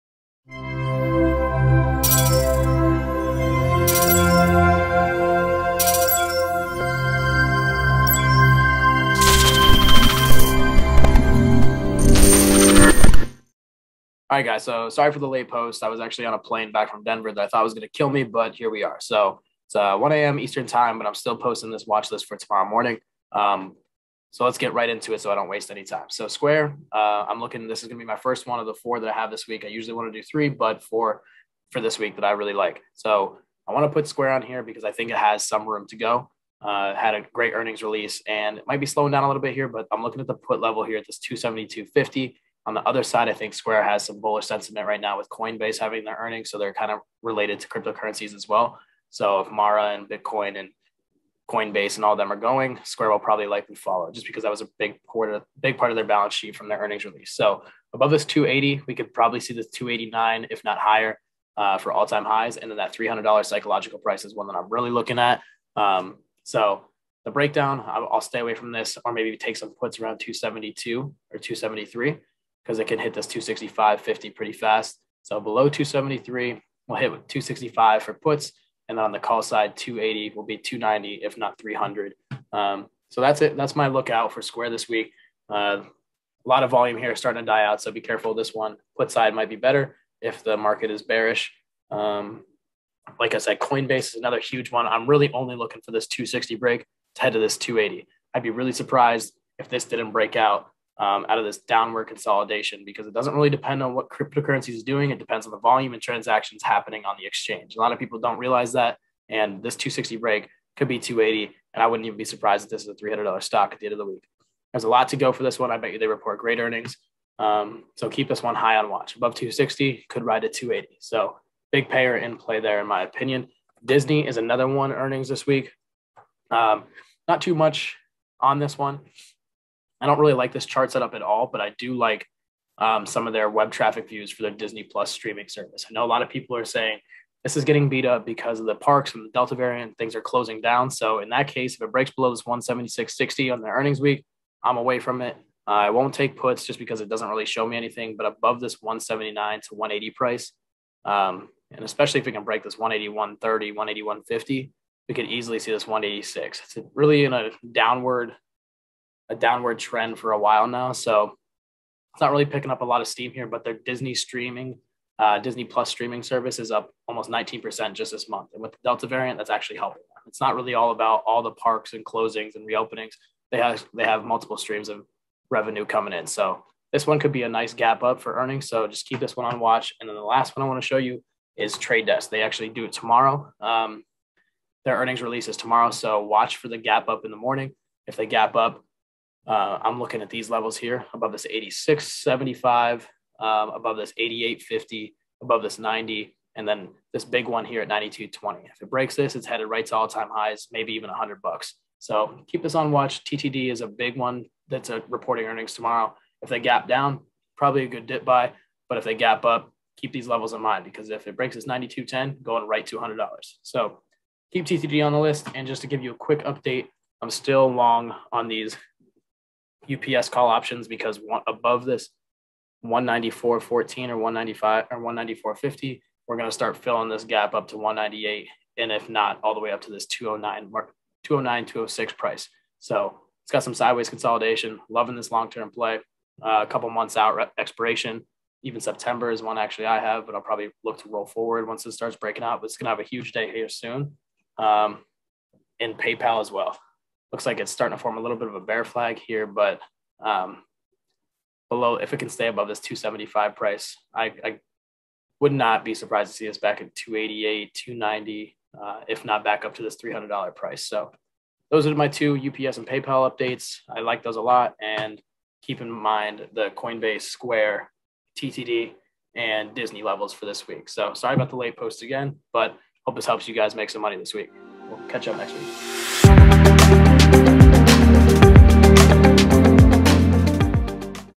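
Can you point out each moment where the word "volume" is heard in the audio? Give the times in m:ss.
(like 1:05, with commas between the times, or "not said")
1:26, 1:45.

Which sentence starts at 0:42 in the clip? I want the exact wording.
On the other side, I think Square has some bullish sentiment right now with Coinbase having their earnings.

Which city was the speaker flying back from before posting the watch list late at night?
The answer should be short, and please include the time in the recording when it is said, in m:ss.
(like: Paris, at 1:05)
Denver, at 0:17.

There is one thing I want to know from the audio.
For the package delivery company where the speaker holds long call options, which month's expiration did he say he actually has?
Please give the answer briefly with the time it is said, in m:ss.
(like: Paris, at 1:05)
September, at 3:58.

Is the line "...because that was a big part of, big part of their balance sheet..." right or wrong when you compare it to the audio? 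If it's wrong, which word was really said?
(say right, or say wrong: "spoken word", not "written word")
right.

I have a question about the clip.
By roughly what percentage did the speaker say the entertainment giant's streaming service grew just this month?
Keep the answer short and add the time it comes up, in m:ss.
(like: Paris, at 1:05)
19%, at 2:47.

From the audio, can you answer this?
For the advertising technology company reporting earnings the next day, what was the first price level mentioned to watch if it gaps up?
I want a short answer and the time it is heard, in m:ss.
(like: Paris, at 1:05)
86.75, at 3:11.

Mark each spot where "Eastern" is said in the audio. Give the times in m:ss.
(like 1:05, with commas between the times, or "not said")
0:20.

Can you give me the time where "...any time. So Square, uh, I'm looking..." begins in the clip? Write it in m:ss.
0:25.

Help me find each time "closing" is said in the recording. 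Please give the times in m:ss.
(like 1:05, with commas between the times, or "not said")
2:20, 2:52.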